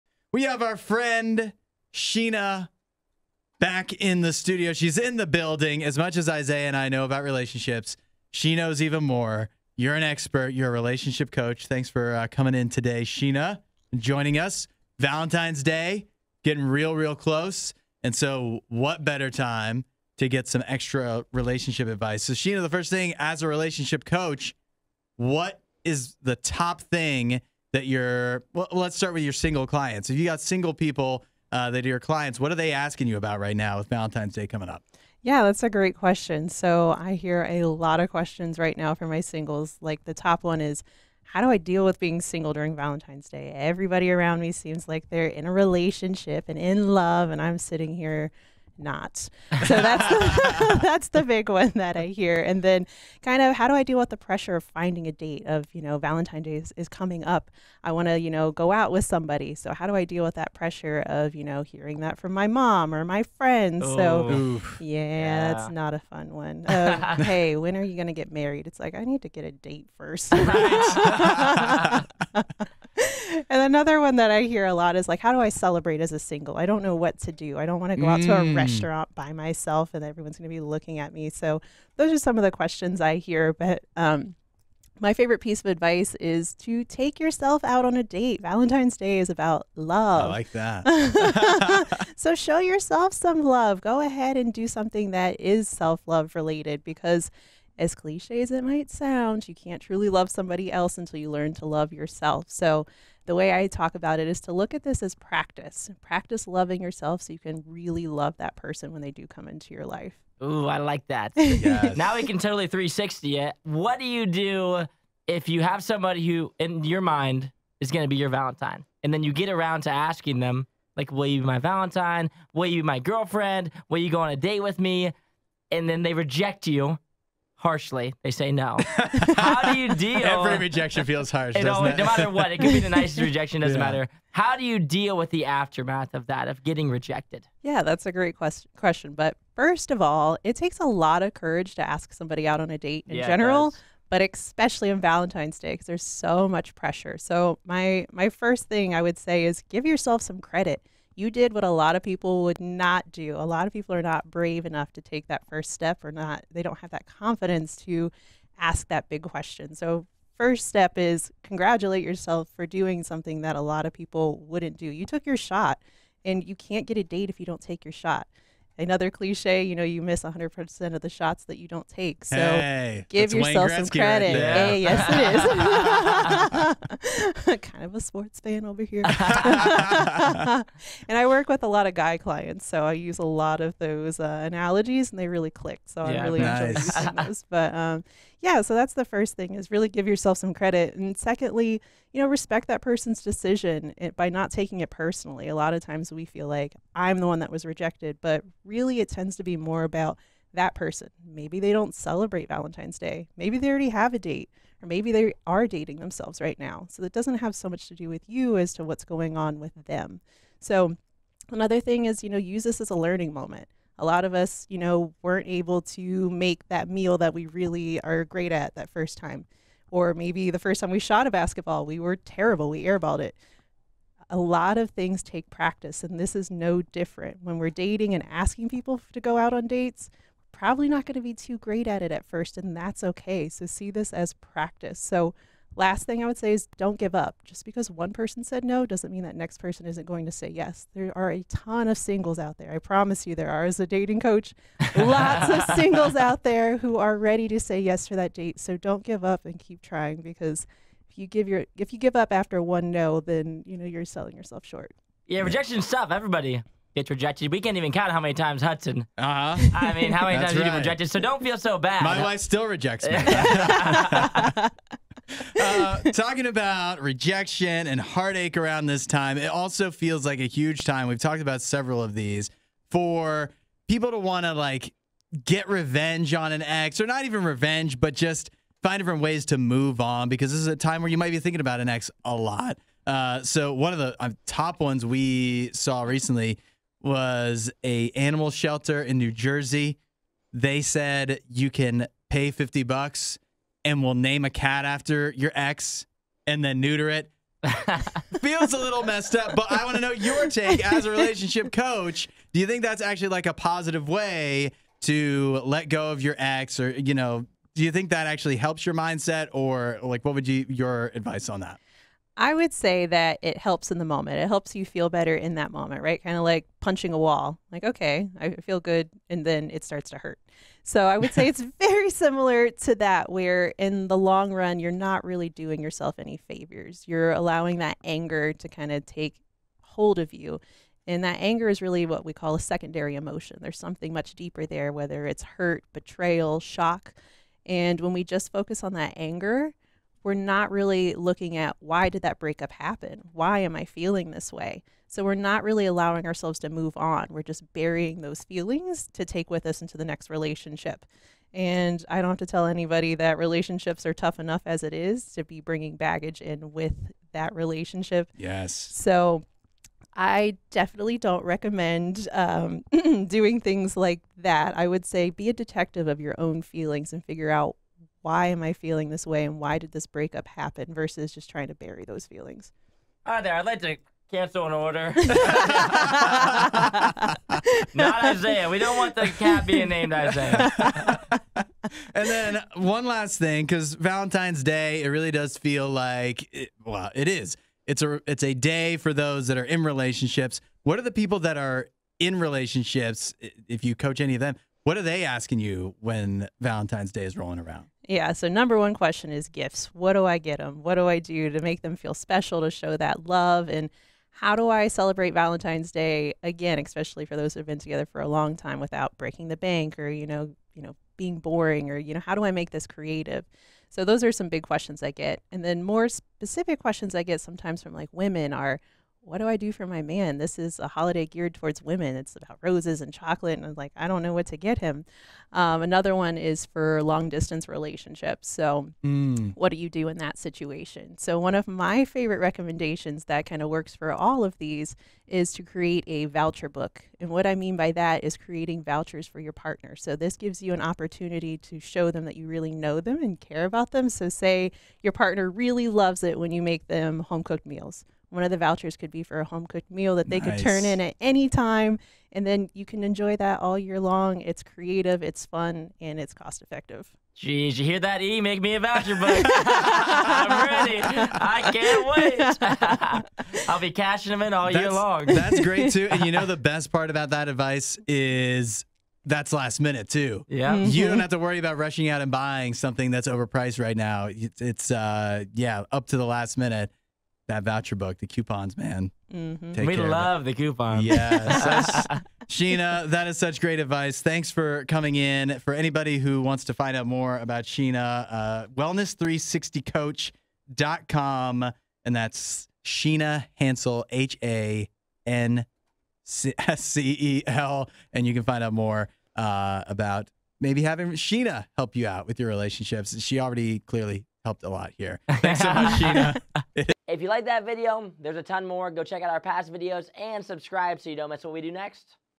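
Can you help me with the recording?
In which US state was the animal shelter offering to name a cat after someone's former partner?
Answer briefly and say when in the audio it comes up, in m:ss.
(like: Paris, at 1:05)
New Jersey, at 4:49.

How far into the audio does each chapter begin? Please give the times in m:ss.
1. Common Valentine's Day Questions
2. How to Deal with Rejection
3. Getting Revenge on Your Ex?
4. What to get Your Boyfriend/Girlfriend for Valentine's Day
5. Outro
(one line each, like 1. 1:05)
1. 0:30
2. 1:52
3. 4:26
4. 6:22
5. 8:00.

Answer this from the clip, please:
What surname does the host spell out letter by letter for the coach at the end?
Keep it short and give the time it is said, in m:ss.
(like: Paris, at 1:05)
Hanscel, at 8:13.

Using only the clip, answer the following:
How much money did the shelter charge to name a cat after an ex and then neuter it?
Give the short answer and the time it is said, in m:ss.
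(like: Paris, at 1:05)
$50, at 4:52.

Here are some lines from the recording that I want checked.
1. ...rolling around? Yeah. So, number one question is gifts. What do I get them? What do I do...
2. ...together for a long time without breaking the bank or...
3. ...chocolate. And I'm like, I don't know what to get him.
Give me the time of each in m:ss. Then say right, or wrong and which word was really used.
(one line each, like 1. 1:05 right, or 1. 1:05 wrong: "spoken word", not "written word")
1. 6:37 right
2. 6:47 right
3. 7:03 right.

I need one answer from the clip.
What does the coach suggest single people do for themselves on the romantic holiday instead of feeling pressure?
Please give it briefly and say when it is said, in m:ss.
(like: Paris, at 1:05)
Take yourself out on a date, at 1:26.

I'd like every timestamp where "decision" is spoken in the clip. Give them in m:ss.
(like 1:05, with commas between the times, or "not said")
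3:13.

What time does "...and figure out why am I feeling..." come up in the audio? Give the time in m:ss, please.
6:07.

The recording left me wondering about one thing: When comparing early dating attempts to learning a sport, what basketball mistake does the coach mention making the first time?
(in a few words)
Airballed it.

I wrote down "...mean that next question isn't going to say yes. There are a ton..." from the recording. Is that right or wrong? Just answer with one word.
wrong.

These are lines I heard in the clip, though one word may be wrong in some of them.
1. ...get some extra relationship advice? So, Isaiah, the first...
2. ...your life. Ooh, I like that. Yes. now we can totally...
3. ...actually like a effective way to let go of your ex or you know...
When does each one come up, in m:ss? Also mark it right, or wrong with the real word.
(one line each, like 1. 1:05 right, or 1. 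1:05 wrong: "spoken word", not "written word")
1. 0:20 wrong: "Sheena", not "Isaiah"
2. 1:49 right
3. 5:03 wrong: "positive", not "effective".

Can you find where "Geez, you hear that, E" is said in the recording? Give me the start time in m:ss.
7:37.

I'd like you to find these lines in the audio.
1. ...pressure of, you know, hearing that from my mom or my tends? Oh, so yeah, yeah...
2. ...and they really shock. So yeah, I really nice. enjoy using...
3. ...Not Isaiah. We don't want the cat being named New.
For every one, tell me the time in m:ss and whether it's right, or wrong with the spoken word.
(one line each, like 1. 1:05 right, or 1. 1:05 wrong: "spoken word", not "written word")
1. 1:00 wrong: "friends", not "tends"
2. 3:05 wrong: "click", not "shock"
3. 6:17 wrong: "Isaiah", not "New".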